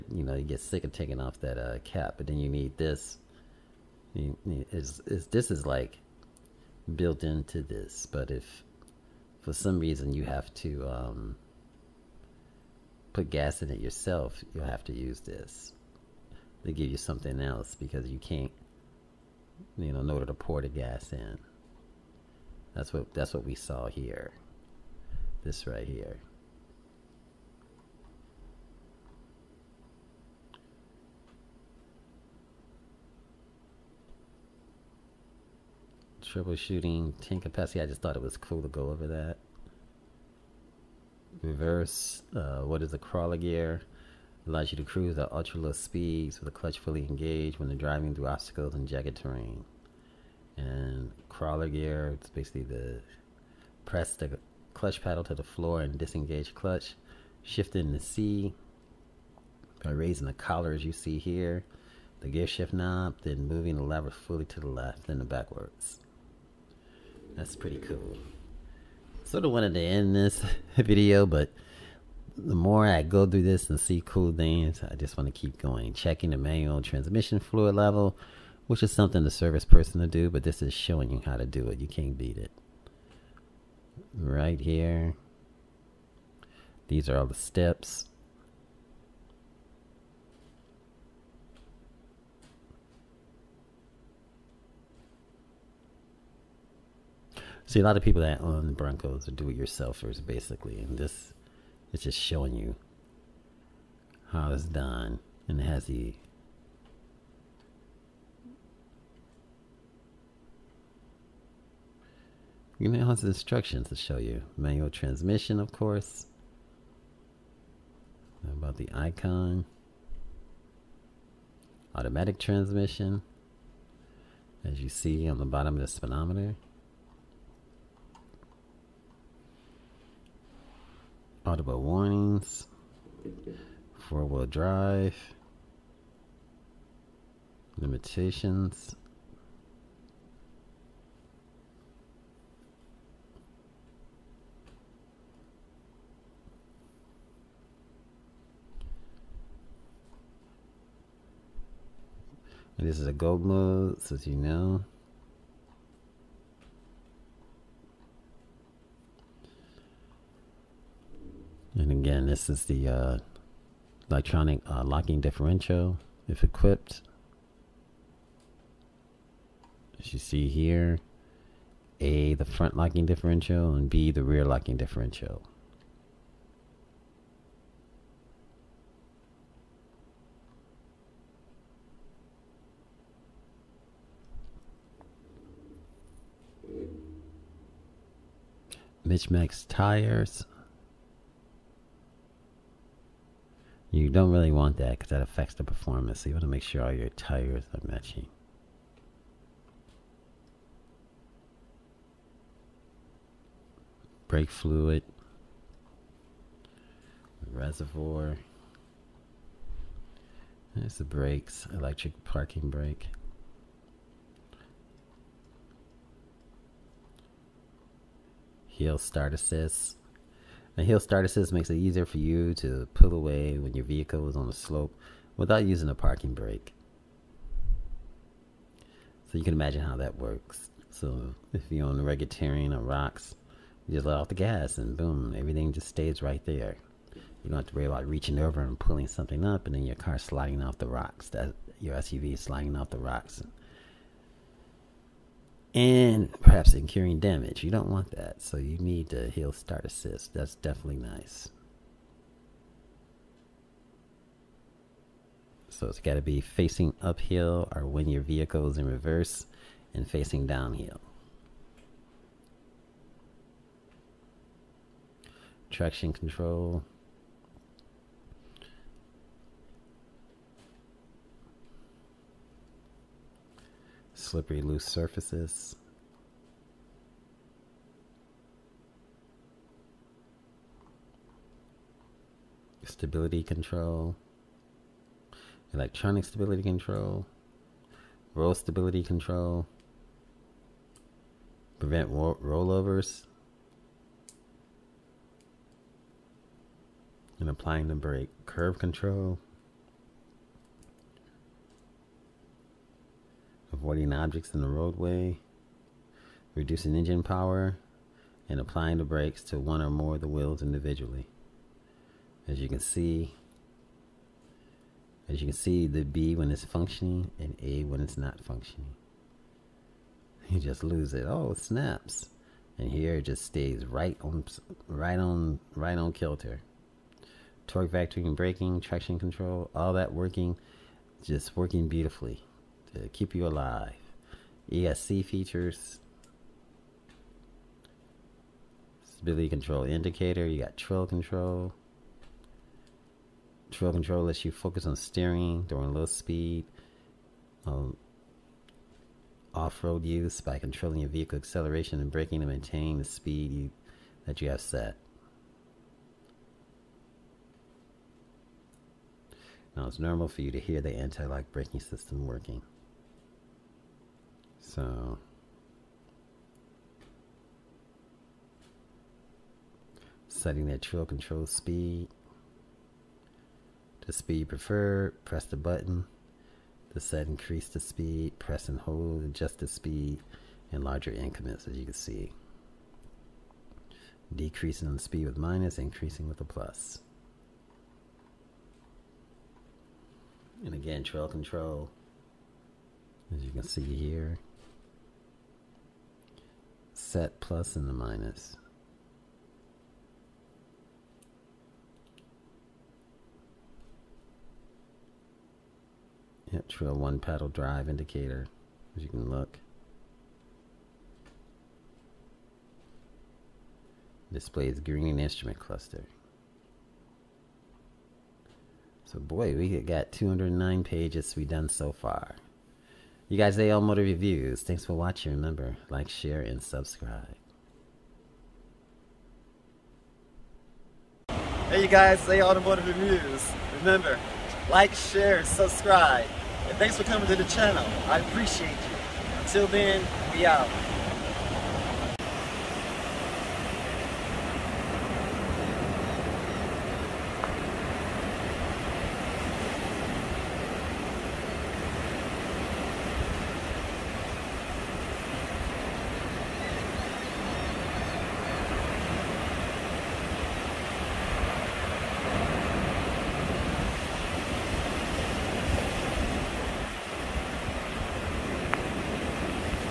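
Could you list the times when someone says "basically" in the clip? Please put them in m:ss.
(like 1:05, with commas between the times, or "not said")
0:52, 1:40.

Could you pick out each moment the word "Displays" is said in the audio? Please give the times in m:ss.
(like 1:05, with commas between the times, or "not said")
6:54.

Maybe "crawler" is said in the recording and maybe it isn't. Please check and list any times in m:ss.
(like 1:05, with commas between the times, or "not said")
0:42, 0:51.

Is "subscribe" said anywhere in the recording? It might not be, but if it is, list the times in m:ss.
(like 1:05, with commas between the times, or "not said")
7:06, 7:15.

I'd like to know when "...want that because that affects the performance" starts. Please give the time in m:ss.
3:14.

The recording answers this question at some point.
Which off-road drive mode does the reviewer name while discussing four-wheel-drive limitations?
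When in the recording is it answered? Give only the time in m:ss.
2:33.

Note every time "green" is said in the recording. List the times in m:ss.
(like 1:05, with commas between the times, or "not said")
6:54.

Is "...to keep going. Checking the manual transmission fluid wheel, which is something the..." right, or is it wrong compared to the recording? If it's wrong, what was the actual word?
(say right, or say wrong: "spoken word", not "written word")
wrong: "level", not "wheel".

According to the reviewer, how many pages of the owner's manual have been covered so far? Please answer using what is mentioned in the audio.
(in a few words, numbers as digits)
209.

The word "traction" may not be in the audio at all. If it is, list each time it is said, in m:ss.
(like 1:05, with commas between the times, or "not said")
4:25, 5:28.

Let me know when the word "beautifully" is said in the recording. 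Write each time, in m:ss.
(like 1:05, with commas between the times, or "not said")
5:31.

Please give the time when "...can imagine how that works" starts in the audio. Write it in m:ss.
3:49.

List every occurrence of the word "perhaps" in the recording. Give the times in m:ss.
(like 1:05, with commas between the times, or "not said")
4:06.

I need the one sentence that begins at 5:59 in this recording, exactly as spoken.
Now it's normal for you to hear the anti-lock braking system working.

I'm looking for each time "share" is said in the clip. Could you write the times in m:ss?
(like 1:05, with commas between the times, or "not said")
7:06, 7:14.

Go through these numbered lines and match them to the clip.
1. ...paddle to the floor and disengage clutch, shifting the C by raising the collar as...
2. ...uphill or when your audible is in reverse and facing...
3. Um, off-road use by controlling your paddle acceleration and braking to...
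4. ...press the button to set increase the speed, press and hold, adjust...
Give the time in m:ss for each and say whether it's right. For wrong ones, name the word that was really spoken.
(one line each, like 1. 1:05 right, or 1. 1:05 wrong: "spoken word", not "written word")
1. 0:55 right
2. 4:17 wrong: "vehicle", not "audible"
3. 5:47 wrong: "vehicle", not "paddle"
4. 6:15 right.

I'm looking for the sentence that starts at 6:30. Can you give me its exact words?
And again, trail control, as you can see here set plus and the minus.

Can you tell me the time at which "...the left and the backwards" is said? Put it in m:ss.
1:04.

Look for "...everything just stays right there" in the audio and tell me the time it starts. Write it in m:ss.
3:55.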